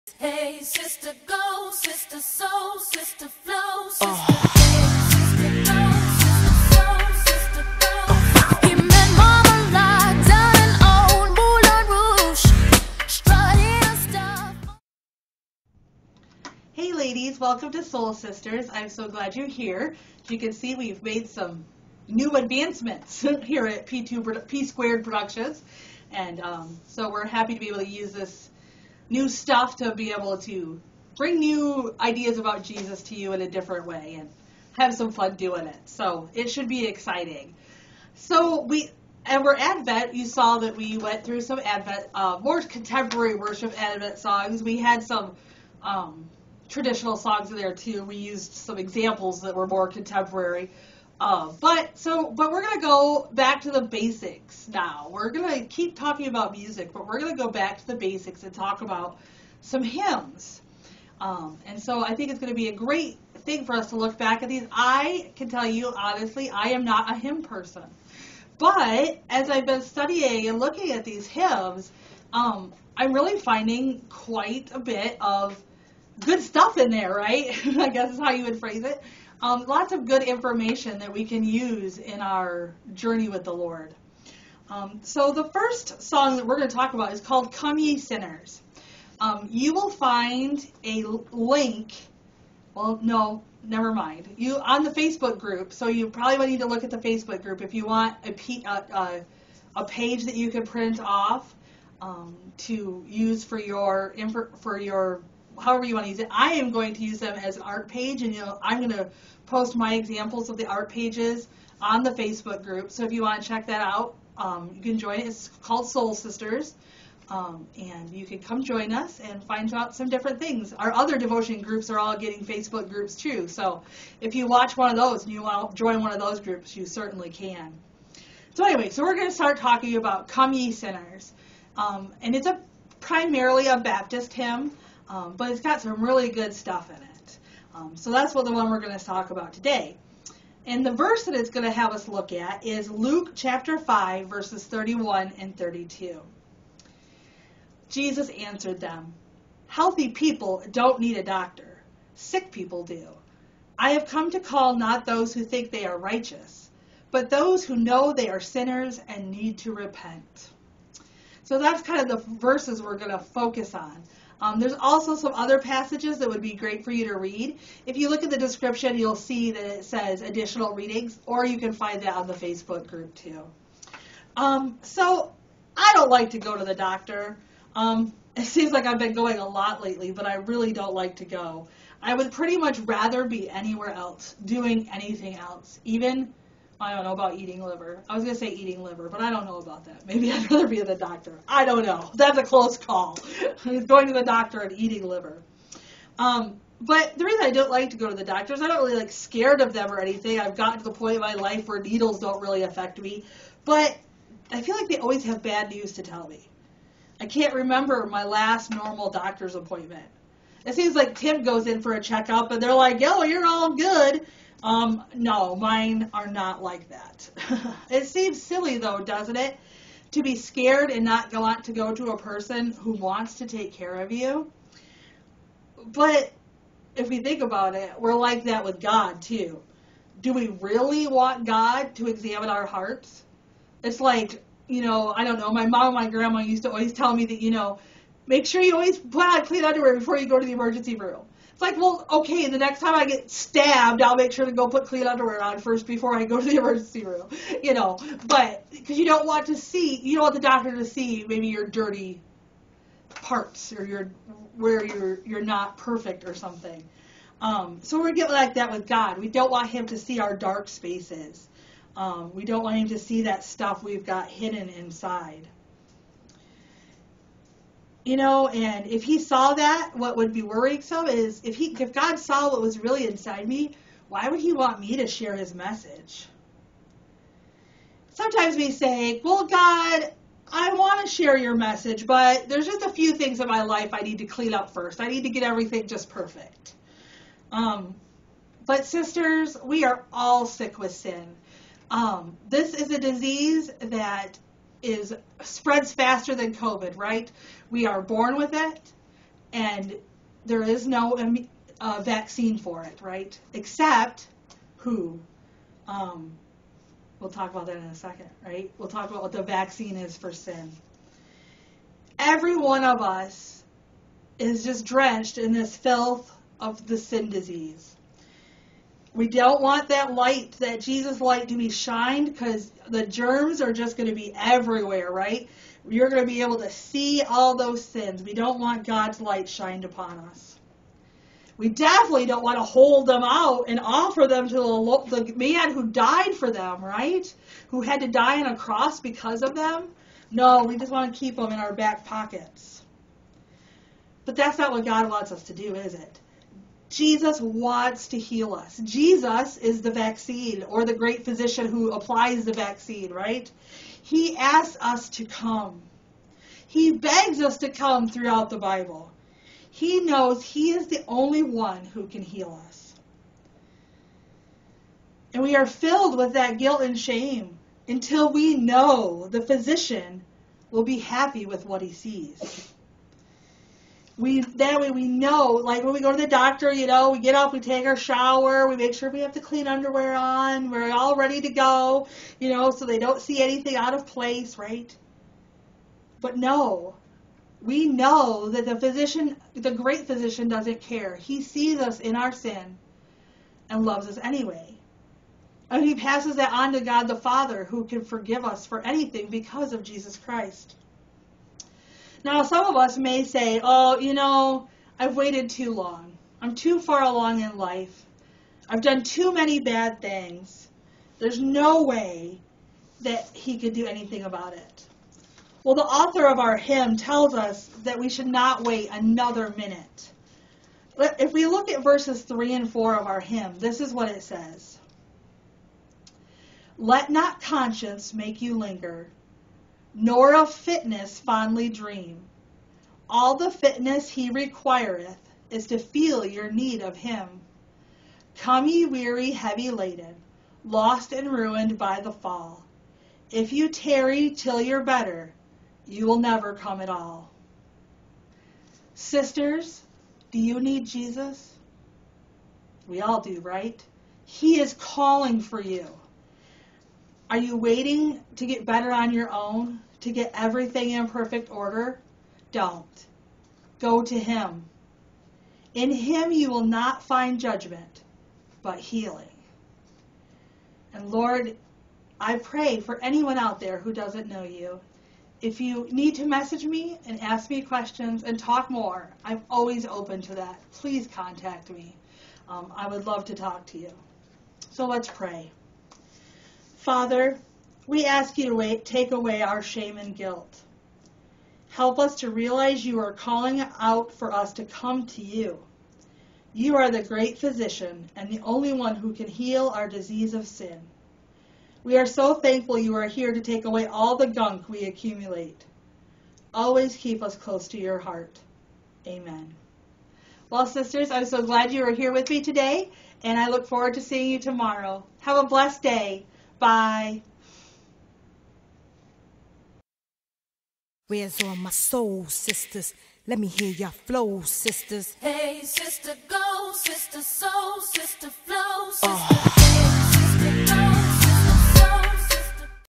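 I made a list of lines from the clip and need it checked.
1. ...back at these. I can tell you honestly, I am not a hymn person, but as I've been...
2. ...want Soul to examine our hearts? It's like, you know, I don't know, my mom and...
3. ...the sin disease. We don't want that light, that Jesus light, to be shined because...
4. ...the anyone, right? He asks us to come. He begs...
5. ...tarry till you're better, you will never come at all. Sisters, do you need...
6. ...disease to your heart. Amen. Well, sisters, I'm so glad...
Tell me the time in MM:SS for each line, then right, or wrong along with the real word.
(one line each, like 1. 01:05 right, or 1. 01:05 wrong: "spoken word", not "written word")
1. 01:04 right
2. 03:51 wrong: "God", not "Soul"
3. 05:16 right
4. 05:52 wrong: "vaccine", not "anyone"
5. 07:23 right
6. 08:27 wrong: "close", not "disease".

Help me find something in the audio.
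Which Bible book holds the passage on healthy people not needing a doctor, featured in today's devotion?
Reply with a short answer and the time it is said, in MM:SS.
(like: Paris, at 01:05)
Luke, at 02:22.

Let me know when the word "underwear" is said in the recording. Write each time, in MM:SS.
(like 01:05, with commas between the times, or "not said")
03:59, 04:05, 06:19.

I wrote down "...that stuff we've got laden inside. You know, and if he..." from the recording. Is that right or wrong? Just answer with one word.
wrong.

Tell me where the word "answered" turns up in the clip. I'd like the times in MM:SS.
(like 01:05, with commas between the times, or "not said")
02:28.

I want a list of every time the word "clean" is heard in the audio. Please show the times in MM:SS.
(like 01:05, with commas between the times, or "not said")
03:59, 04:04, 04:44, 06:19.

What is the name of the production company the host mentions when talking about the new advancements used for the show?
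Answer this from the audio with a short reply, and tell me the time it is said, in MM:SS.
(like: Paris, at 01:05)
P Squared Productions, at 00:23.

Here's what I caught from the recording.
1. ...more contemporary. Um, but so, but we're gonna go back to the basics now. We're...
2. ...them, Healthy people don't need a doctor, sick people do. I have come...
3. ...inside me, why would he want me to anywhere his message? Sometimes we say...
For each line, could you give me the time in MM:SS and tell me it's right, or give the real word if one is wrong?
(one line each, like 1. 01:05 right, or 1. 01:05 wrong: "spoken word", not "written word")
1. 00:49 right
2. 02:28 right
3. 04:33 wrong: "share", not "anywhere".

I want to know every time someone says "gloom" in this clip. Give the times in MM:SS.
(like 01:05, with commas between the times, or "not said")
not said.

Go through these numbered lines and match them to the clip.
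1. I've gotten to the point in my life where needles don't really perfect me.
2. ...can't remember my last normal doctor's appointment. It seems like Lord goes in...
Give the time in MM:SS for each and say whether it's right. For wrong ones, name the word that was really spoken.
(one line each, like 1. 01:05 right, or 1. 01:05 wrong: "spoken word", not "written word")
1. 03:20 wrong: "affect", not "perfect"
2. 03:27 wrong: "Tim", not "Lord".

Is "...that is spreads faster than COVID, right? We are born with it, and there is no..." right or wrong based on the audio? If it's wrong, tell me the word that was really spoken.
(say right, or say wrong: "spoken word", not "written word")
right.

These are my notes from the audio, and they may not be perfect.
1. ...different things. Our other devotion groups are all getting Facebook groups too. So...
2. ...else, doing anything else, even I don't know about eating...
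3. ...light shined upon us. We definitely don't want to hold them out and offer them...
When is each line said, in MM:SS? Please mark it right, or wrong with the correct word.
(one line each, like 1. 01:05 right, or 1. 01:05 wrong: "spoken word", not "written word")
1. 02:00 right
2. 03:03 right
3. 05:29 right.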